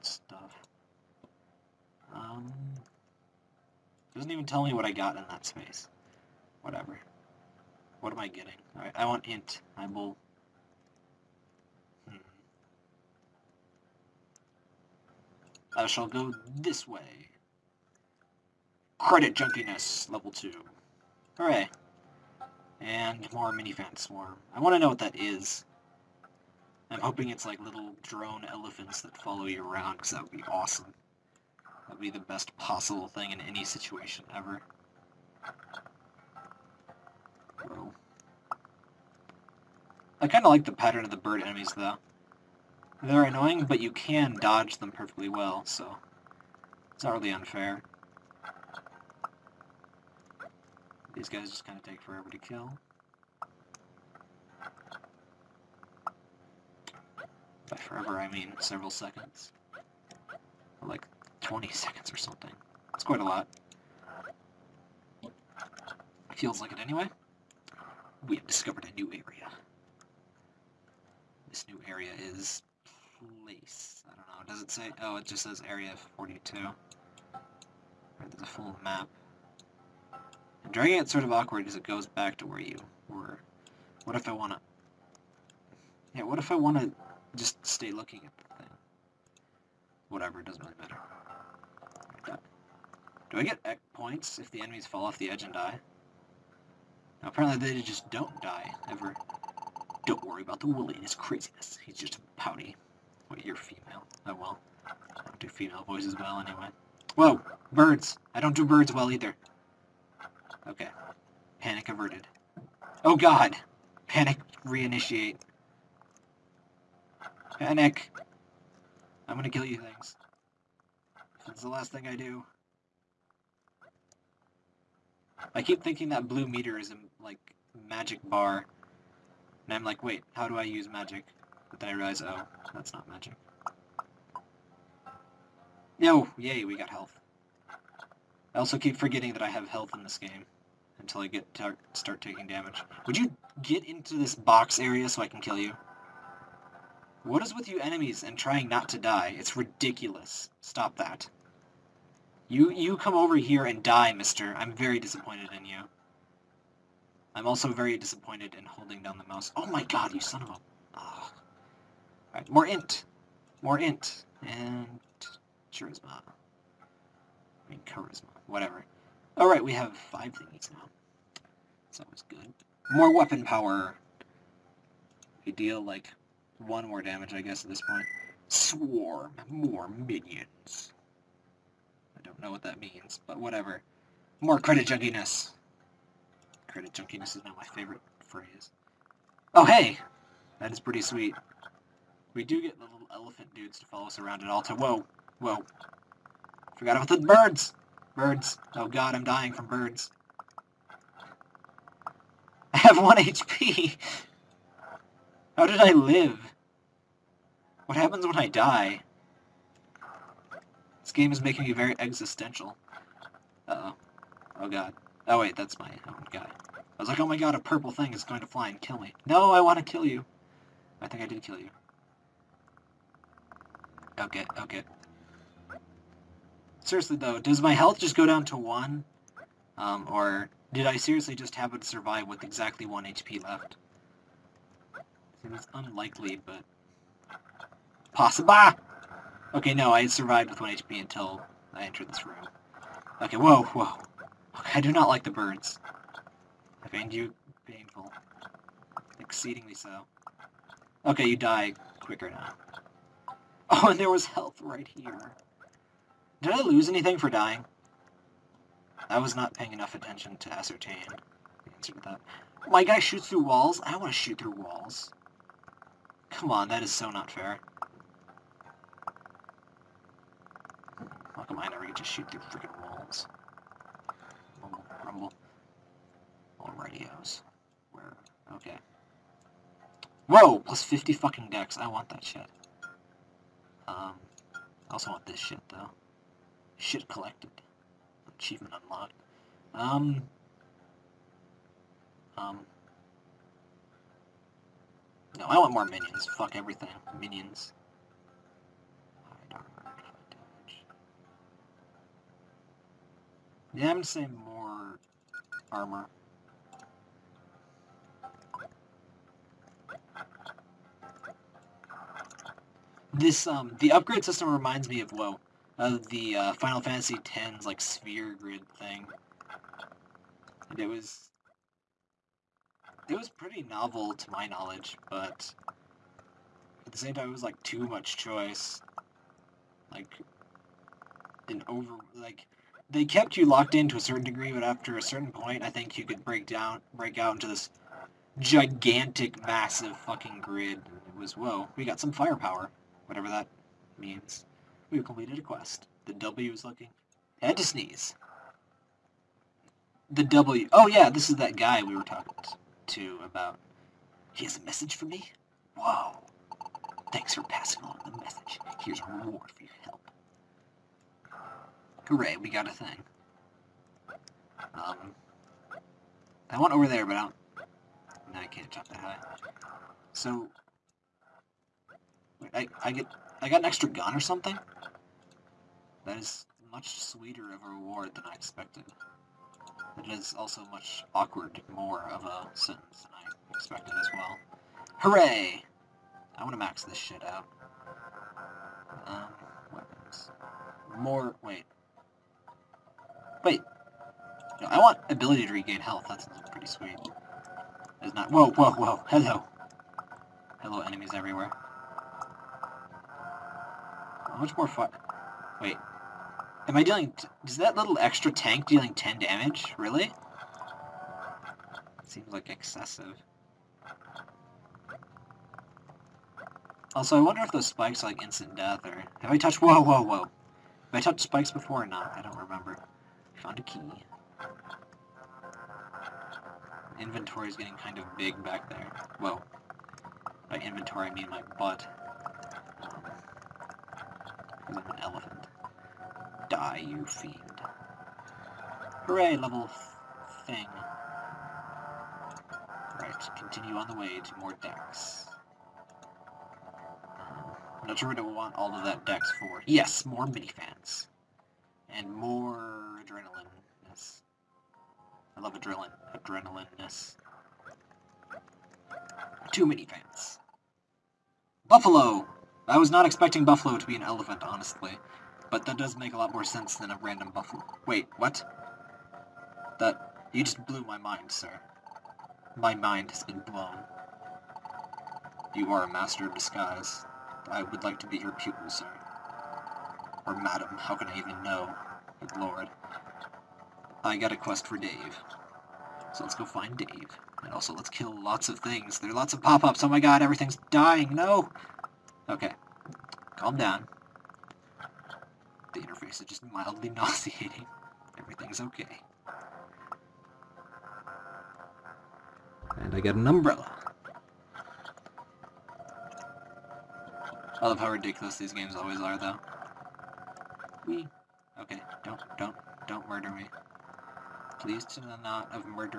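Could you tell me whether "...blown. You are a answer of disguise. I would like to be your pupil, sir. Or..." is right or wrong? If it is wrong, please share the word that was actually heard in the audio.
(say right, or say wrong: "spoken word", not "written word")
wrong: "master", not "answer".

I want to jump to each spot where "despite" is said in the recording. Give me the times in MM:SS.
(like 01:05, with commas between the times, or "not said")
not said.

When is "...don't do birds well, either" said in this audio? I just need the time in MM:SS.
01:48.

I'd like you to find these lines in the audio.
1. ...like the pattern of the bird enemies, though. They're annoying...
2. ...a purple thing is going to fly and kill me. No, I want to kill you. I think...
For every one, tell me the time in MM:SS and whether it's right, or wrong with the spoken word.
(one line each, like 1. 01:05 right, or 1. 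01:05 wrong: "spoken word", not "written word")
1. 00:40 right
2. 03:37 right.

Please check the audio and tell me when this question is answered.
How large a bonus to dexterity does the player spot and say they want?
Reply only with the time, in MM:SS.
04:40.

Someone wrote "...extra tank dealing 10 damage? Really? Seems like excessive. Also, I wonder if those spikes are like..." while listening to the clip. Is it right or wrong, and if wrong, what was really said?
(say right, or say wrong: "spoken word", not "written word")
right.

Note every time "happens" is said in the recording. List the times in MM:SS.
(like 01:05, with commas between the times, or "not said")
03:27, 03:51.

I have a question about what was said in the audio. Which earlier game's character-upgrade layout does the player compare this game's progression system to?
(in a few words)
Final Fantasy X.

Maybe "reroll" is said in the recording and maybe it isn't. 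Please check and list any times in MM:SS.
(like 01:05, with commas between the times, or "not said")
not said.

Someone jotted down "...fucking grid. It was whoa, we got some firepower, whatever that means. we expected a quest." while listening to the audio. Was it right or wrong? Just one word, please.
wrong.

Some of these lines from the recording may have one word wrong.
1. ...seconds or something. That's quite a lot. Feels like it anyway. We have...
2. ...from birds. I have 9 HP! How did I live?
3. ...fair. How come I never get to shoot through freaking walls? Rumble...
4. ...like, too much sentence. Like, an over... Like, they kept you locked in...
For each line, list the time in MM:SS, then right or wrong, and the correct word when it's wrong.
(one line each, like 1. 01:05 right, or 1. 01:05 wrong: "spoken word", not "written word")
1. 01:01 right
2. 03:19 wrong: "1", not "9"
3. 04:27 right
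4. 05:27 wrong: "choice", not "sentence".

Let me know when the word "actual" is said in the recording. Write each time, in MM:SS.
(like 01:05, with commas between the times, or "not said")
not said.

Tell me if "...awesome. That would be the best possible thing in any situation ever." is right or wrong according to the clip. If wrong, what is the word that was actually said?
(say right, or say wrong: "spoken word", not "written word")
right.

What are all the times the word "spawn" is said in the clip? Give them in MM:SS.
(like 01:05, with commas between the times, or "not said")
not said.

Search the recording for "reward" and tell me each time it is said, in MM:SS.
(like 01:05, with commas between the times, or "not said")
05:59, 06:17.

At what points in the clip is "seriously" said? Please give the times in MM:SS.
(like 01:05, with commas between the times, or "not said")
03:46, 03:50.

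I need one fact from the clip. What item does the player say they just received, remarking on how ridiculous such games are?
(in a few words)
umbrella.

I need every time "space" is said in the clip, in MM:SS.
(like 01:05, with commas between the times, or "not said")
00:05.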